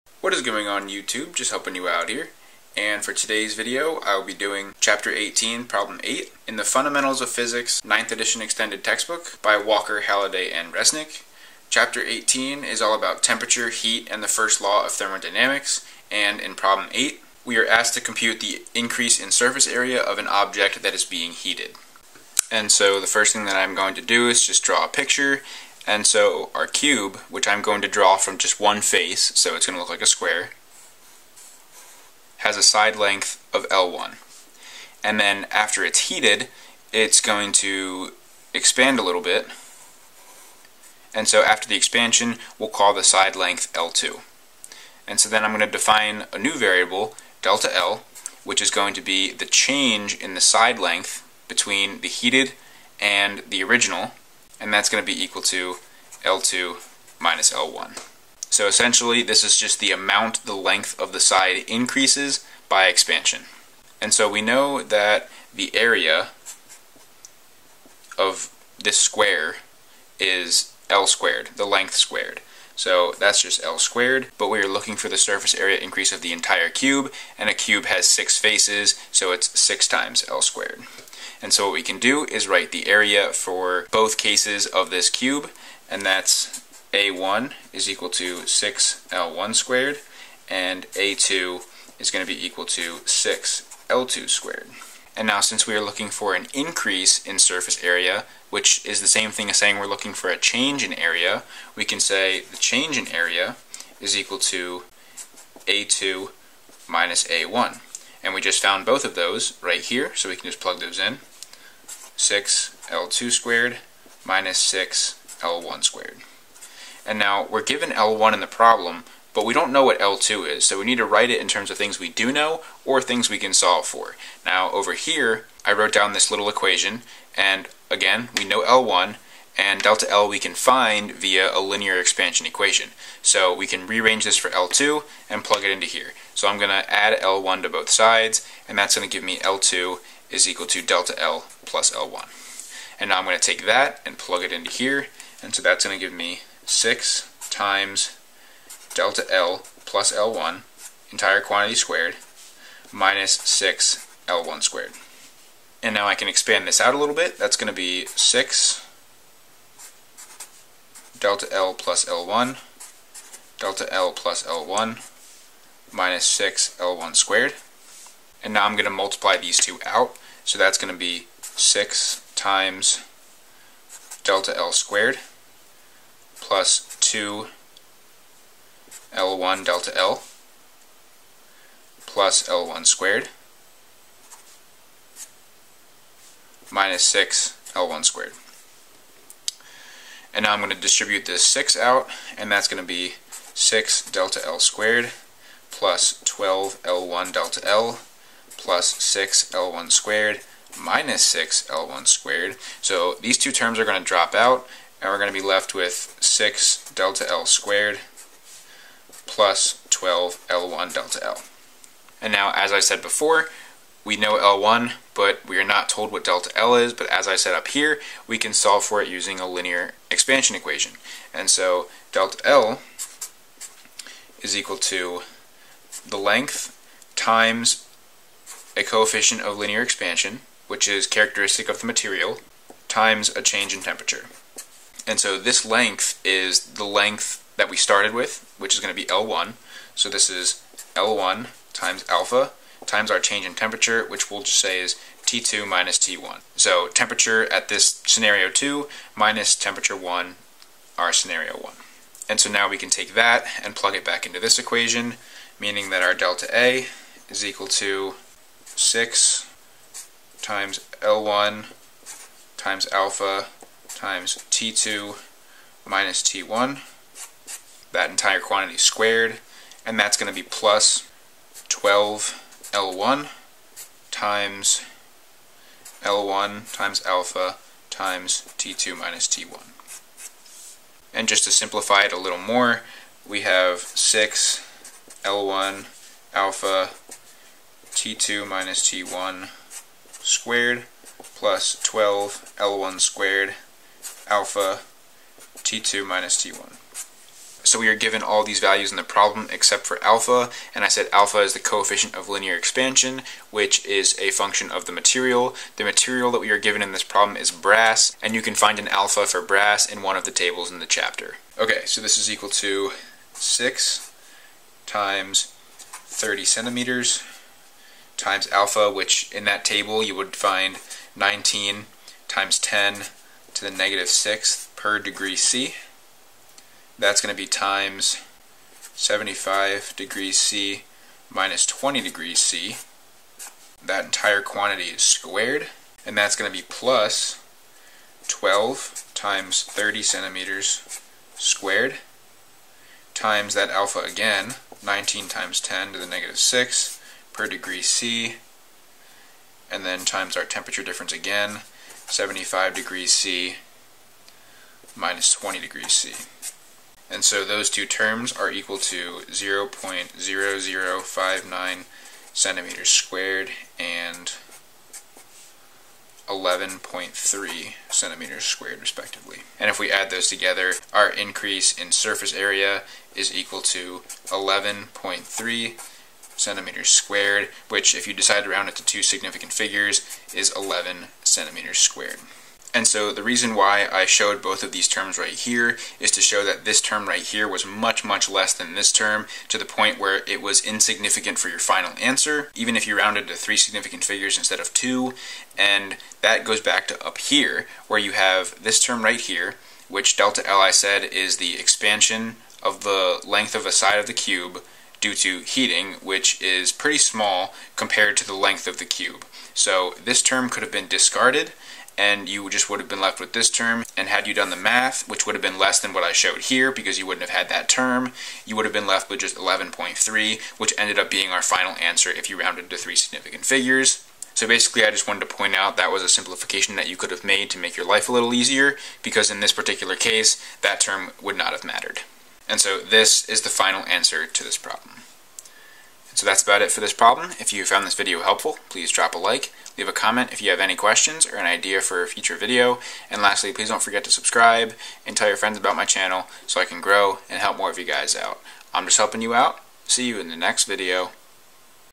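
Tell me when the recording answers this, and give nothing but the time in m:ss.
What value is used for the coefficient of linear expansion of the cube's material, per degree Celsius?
5:21.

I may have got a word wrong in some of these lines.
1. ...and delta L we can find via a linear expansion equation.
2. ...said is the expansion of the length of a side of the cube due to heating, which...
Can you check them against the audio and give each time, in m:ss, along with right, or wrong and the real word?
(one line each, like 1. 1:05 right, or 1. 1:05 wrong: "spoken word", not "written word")
1. 2:09 right
2. 6:40 right.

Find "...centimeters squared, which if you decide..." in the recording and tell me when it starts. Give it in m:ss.
6:16.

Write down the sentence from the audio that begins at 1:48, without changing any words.
And we just found both of those right here, so we can just plug those in.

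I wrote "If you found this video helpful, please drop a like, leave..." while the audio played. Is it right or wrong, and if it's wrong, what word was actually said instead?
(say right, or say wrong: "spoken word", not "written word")
right.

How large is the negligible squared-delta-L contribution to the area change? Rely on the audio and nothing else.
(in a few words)
0.0059 cm².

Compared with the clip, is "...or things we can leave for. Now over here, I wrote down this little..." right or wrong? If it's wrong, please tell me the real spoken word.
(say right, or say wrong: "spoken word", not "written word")
wrong: "solve", not "leave".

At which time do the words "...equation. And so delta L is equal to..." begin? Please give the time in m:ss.
3:40.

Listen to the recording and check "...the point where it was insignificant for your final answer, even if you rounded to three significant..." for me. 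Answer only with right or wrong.
right.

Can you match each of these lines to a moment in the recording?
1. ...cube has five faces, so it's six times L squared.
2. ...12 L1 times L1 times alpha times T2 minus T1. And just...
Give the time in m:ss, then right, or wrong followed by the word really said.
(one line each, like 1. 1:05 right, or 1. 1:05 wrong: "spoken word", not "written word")
1. 1:17 wrong: "six", not "five"
2. 4:31 right.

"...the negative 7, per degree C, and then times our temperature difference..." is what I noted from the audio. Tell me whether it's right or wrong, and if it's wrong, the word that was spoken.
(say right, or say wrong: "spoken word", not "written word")
wrong: "6", not "7".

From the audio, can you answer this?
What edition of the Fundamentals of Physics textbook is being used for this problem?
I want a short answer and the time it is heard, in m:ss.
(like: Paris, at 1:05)
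9th Edition, at 0:07.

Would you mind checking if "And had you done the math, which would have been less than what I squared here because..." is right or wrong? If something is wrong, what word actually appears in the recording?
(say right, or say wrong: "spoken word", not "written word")
wrong: "showed", not "squared".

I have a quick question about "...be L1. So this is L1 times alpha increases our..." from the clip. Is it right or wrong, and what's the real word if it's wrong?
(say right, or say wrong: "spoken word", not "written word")
wrong: "times", not "increases".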